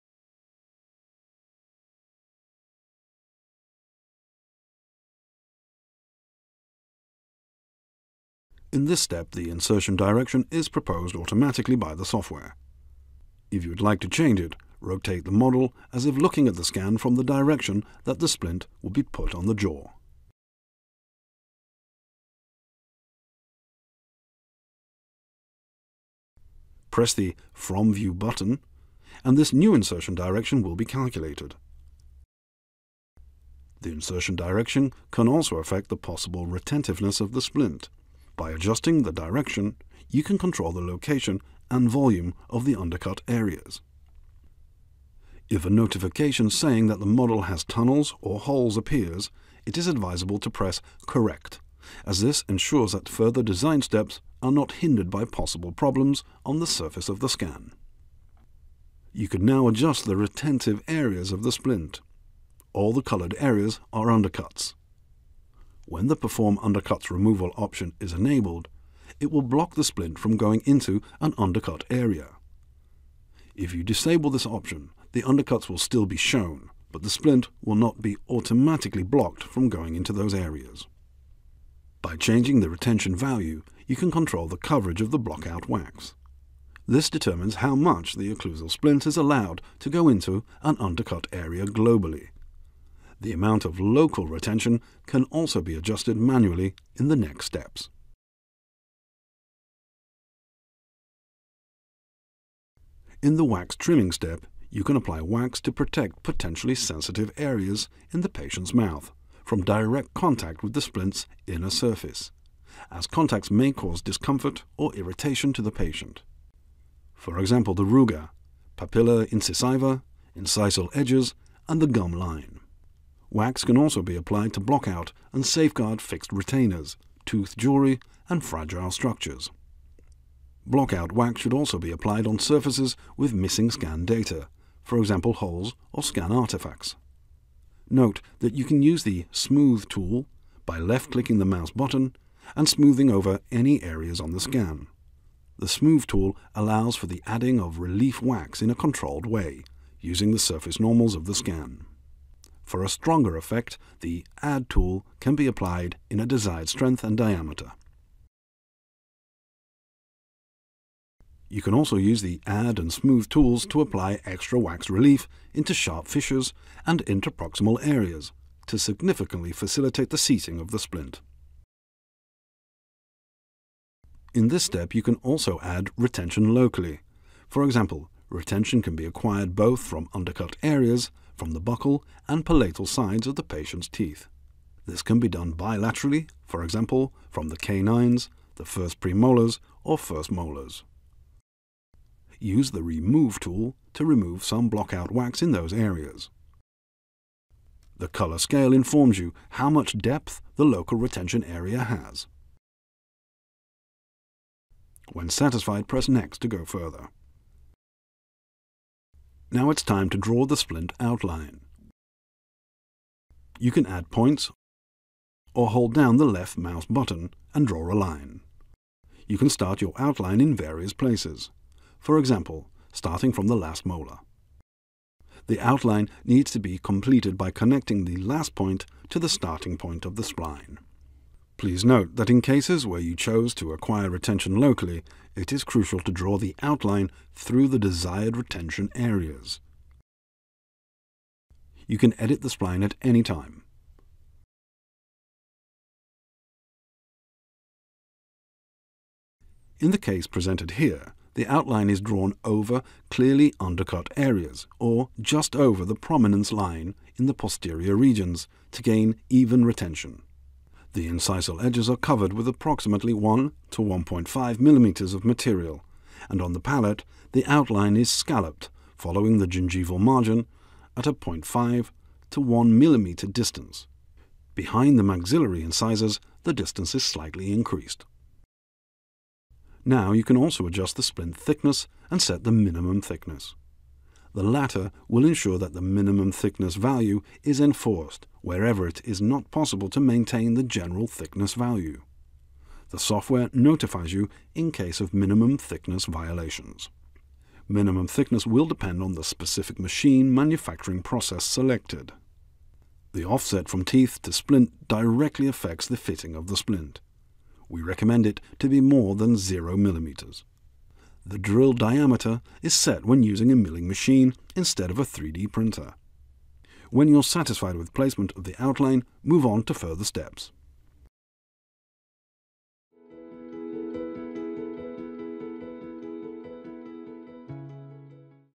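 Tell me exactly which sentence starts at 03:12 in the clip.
Use the remove tool to remove some blockout wax in those areas.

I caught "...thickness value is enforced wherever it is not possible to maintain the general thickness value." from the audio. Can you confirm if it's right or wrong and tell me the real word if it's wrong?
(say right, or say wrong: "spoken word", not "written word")
right.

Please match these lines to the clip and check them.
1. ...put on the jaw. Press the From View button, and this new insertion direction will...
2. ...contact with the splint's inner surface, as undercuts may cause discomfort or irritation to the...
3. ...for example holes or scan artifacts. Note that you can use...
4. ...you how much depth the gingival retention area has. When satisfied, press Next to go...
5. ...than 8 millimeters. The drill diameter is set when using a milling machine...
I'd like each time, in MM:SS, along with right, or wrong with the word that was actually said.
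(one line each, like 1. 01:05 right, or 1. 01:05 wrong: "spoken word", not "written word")
1. 00:19 right
2. 01:50 wrong: "contacts", not "undercuts"
3. 02:14 right
4. 03:19 wrong: "local", not "gingival"
5. 05:09 wrong: "0", not "8".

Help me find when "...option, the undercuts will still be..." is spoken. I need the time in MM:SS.
01:14.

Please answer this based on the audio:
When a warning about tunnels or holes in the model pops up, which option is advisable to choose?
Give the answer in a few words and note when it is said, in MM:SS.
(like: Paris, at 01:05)
Correct, at 00:51.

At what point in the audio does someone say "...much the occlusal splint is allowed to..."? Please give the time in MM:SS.
01:27.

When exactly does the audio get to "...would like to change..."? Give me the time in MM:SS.
00:13.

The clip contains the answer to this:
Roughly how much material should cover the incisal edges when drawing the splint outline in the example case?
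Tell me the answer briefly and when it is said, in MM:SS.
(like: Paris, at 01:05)
1 to 1.5 millimeters, at 04:23.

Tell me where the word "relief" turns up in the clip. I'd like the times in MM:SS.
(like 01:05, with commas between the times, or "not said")
02:27, 02:44.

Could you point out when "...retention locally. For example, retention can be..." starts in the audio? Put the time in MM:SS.
02:55.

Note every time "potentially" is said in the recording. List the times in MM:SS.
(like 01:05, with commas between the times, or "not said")
01:46.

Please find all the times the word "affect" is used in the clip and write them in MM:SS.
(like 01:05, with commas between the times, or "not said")
00:35, 05:05.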